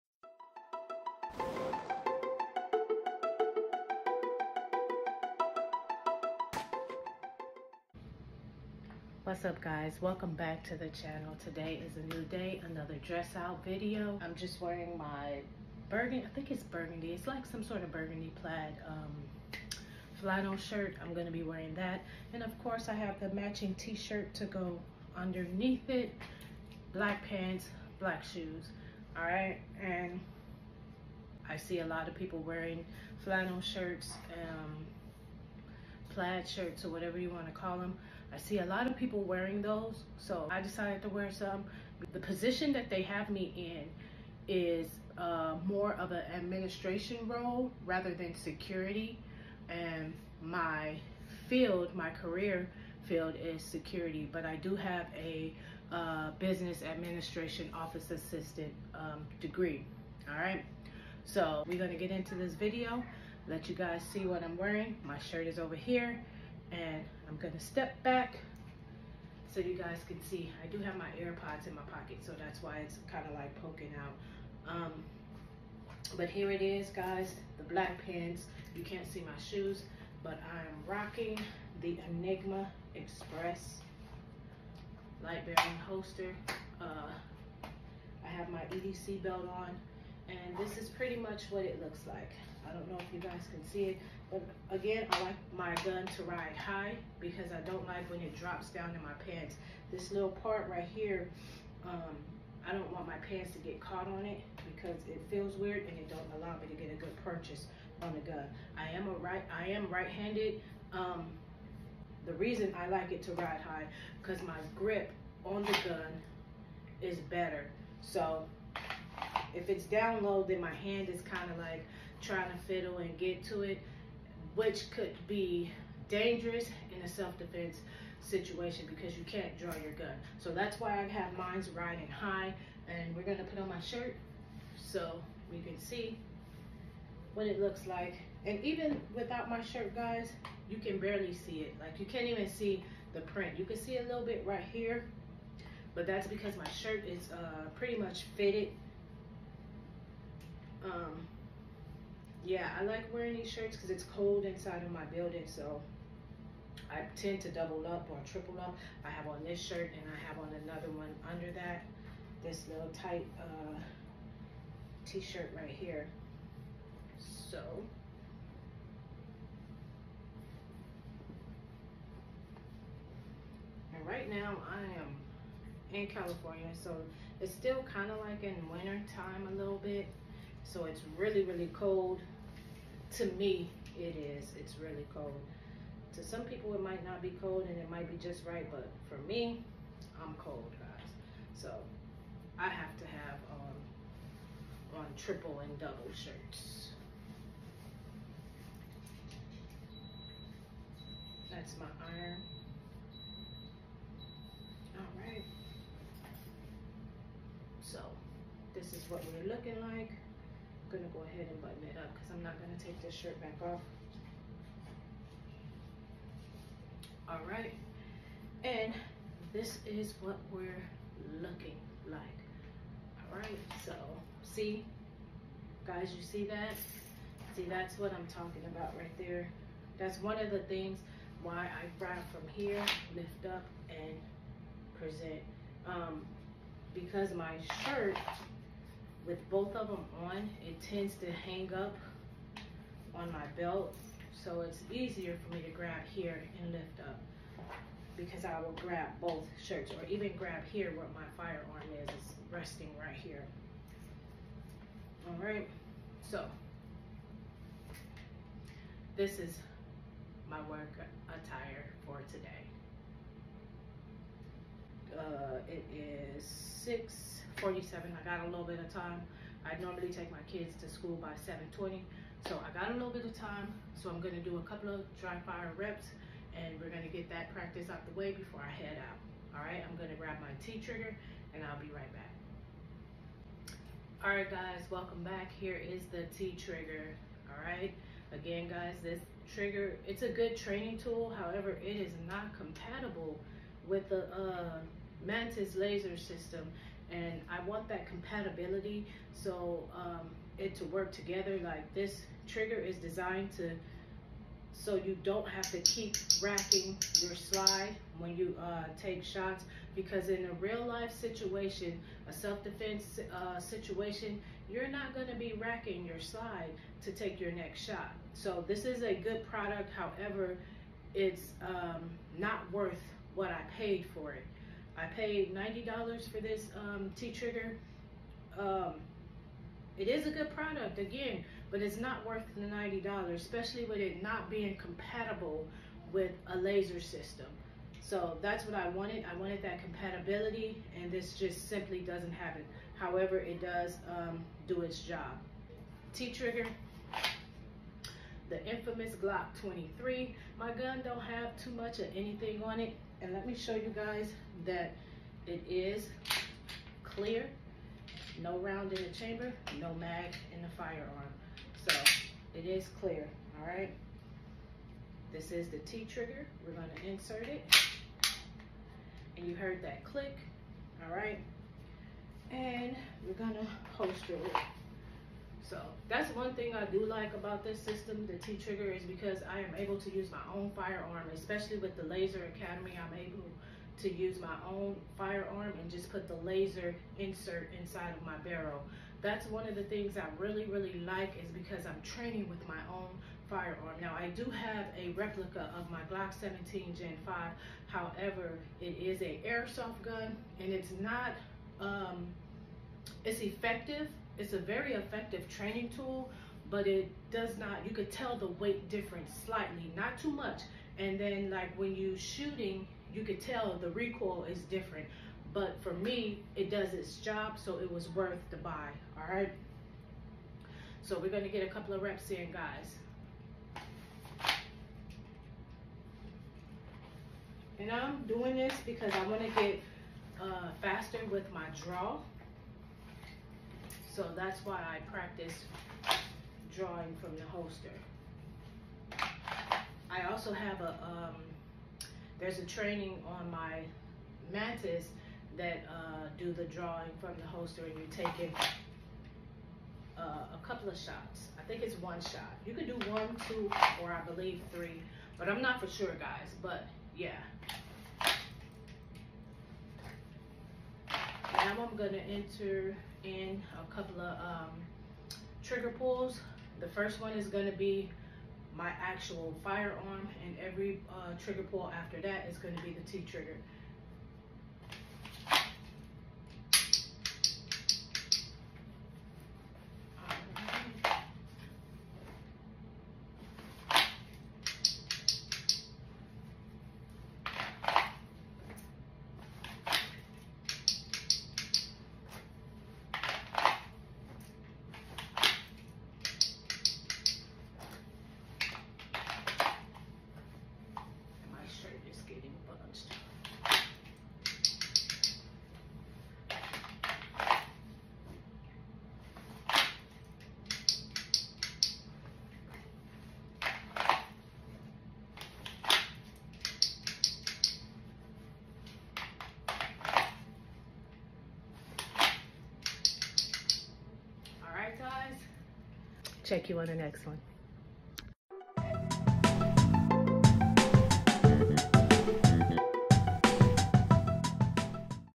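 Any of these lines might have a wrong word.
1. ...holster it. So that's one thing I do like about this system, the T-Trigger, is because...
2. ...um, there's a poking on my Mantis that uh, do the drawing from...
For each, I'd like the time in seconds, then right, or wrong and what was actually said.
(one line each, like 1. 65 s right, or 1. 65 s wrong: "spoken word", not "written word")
1. 373 s right
2. 441 s wrong: "training", not "poking".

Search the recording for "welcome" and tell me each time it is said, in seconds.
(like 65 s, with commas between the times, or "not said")
10 s, 284 s.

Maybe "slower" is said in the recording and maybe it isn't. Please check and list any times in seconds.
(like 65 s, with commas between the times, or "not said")
not said.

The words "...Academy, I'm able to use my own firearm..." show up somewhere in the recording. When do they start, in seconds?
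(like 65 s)
382 s.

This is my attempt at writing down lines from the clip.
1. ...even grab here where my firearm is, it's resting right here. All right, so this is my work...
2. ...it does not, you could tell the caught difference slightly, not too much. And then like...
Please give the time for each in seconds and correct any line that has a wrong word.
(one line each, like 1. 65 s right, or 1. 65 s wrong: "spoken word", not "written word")
1. 250 s right
2. 406 s wrong: "weight", not "caught".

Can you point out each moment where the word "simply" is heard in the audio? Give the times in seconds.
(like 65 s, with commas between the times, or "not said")
341 s.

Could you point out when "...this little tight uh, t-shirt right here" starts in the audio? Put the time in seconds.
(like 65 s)
162 s.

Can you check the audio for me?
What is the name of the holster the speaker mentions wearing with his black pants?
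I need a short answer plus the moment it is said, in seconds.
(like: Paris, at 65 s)
Enigma Express, at 82 s.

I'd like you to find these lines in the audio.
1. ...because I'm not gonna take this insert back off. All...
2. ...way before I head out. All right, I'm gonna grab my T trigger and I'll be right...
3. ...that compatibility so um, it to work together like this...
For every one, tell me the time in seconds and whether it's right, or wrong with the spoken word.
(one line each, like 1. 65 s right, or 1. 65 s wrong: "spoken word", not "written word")
1. 212 s wrong: "shirt", not "insert"
2. 278 s right
3. 297 s right.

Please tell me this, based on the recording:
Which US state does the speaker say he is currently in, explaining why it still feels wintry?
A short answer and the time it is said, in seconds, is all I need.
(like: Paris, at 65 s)
California, at 176 s.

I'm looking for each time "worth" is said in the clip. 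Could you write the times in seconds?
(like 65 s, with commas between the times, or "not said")
322 s, 332 s, 418 s.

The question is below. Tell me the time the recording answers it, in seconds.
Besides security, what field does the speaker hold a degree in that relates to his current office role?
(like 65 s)
56 s.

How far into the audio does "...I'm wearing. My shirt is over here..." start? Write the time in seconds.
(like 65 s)
64 s.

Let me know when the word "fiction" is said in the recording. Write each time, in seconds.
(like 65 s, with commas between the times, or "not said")
not said.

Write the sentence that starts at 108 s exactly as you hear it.
I am a right, I am right-handed.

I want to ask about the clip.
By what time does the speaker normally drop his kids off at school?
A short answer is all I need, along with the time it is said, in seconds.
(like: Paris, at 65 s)
7:20, at 271 s.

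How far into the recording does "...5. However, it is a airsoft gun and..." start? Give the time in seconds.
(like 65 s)
397 s.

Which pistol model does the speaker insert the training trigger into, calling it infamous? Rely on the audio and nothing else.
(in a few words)
Glock 23.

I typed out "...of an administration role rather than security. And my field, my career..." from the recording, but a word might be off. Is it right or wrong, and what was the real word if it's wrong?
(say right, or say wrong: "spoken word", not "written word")
right.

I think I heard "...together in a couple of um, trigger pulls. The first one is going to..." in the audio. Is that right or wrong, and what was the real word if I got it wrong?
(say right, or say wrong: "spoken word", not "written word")
wrong: "enter", not "together".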